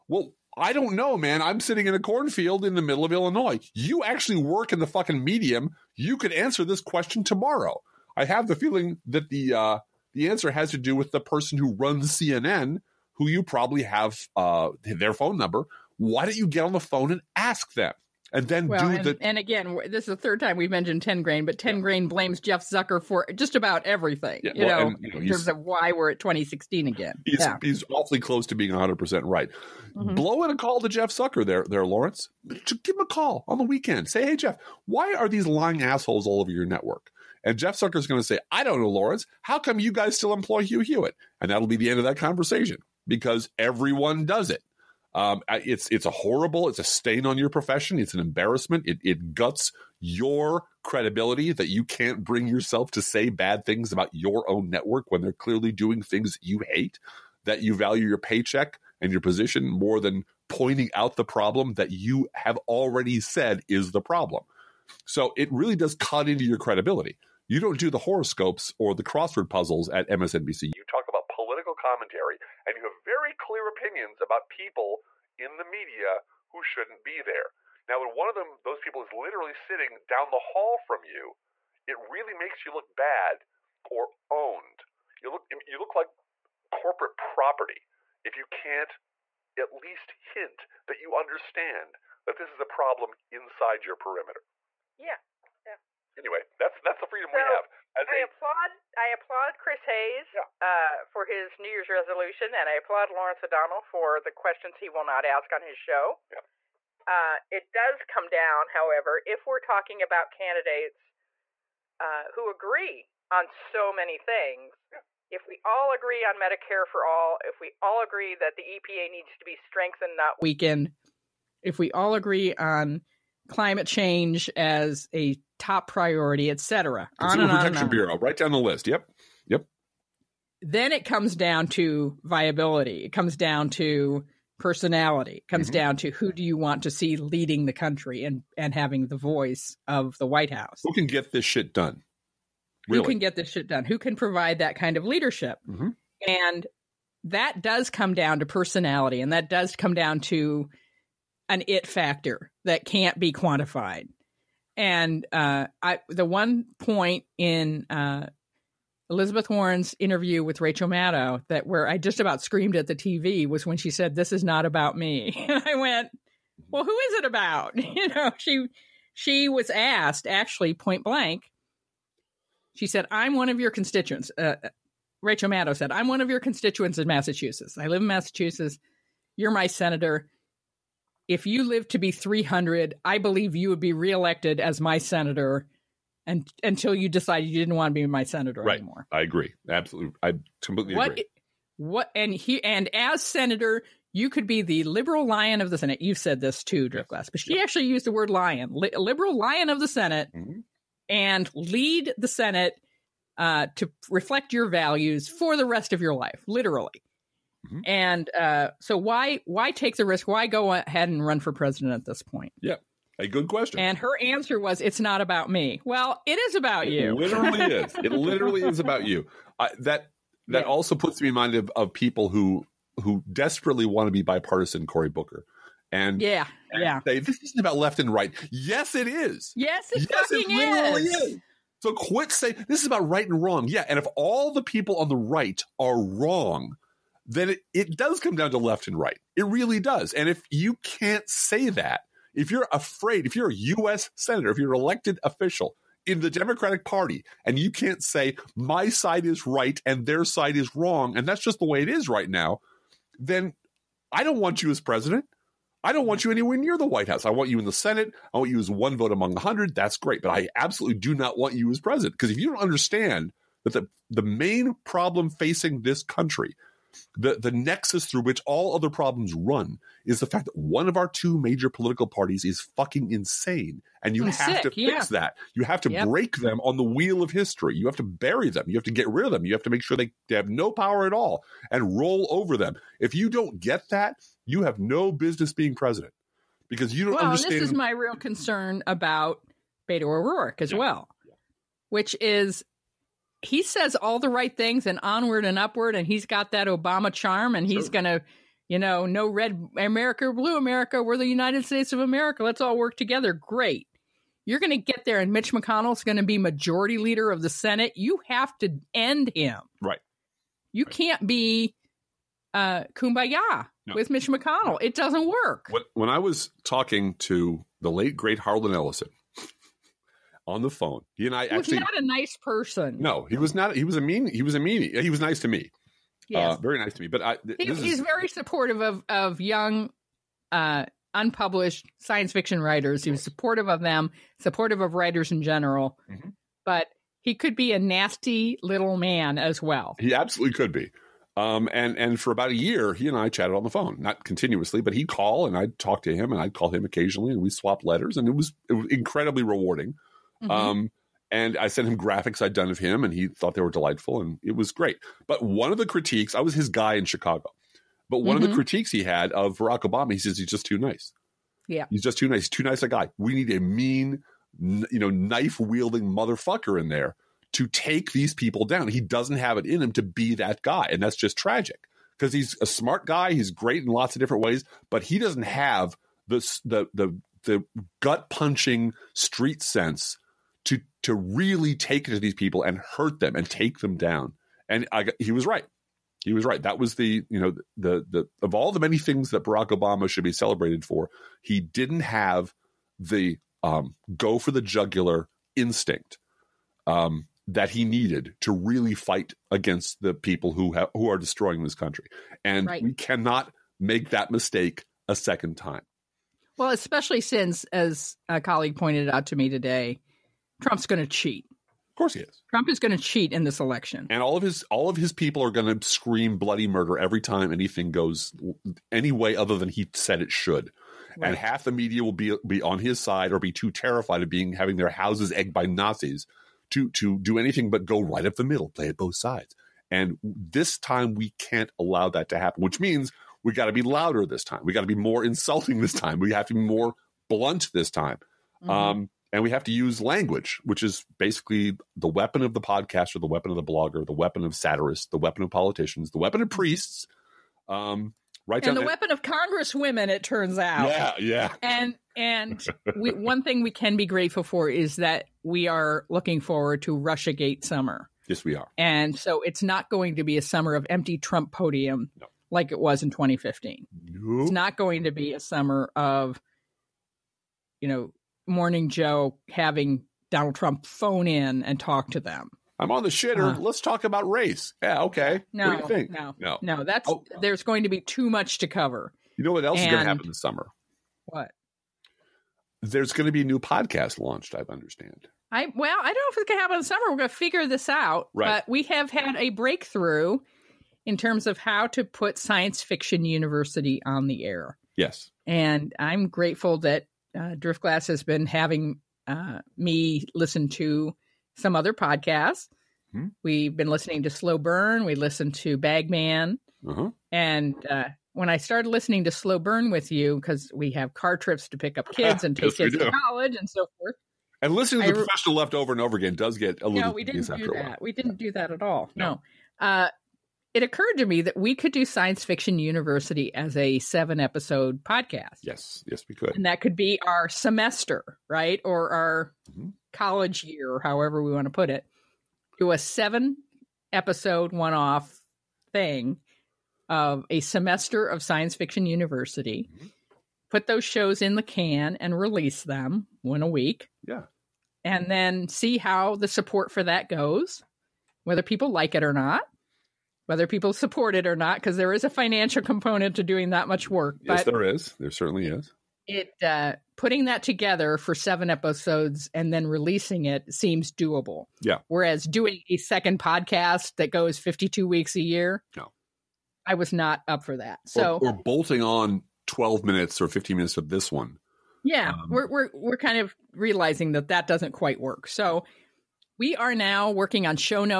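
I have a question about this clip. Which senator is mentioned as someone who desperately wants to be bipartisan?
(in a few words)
Cory Booker.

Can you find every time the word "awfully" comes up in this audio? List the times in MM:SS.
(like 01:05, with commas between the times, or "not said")
00:27.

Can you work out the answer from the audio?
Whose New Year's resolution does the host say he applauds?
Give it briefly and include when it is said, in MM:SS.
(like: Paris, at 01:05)
Chris Hayes, at 01:39.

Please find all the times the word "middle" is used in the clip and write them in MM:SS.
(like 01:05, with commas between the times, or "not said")
00:02, 07:08.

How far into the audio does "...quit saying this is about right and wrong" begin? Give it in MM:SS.
03:51.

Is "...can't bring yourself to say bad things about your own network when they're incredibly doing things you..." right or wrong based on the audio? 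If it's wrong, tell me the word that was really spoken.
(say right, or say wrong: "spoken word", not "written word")
wrong: "clearly", not "incredibly".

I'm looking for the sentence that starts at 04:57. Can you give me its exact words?
gonna, you know, no red America, blue America.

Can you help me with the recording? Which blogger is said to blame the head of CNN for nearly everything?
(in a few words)
Tengrain.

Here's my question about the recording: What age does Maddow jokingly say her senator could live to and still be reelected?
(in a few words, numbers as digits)
300.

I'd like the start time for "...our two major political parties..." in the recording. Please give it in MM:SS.
04:30.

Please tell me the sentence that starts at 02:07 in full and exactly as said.
Consumer Protection Bureau, right down the list.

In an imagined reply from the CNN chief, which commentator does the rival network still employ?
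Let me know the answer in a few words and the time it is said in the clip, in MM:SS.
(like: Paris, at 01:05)
Hugh Hewitt, at 00:40.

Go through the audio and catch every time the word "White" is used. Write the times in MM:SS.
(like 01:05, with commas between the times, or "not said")
02:20, 04:16.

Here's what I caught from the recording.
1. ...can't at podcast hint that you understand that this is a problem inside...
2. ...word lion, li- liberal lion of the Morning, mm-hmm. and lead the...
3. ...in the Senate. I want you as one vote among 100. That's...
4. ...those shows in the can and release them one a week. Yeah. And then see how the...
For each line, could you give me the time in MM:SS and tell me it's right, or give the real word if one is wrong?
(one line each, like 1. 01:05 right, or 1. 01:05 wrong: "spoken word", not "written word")
1. 01:28 wrong: "least", not "podcast"
2. 03:18 wrong: "Senate", not "Morning"
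3. 04:17 right
4. 09:00 right.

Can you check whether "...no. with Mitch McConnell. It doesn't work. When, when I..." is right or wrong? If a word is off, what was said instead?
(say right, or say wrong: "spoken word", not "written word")
right.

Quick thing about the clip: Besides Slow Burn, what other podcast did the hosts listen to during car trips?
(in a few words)
Bagman.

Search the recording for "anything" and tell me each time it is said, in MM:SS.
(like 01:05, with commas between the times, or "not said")
06:57, 07:07.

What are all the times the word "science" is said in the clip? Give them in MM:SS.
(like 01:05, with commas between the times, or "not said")
05:31, 08:12, 08:42, 08:58.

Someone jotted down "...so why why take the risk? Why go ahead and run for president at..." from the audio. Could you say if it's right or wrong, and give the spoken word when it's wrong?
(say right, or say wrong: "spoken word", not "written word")
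right.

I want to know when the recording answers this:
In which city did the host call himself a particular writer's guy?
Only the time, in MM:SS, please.
05:57.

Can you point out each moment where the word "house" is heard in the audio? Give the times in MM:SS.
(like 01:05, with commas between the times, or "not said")
02:20, 04:17, 07:04.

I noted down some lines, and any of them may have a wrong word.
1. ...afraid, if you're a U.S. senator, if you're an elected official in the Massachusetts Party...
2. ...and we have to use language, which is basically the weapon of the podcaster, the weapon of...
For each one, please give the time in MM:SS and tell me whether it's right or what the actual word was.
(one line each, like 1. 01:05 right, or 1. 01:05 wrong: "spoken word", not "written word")
1. 04:02 wrong: "Democratic", not "Massachusetts"
2. 07:19 right.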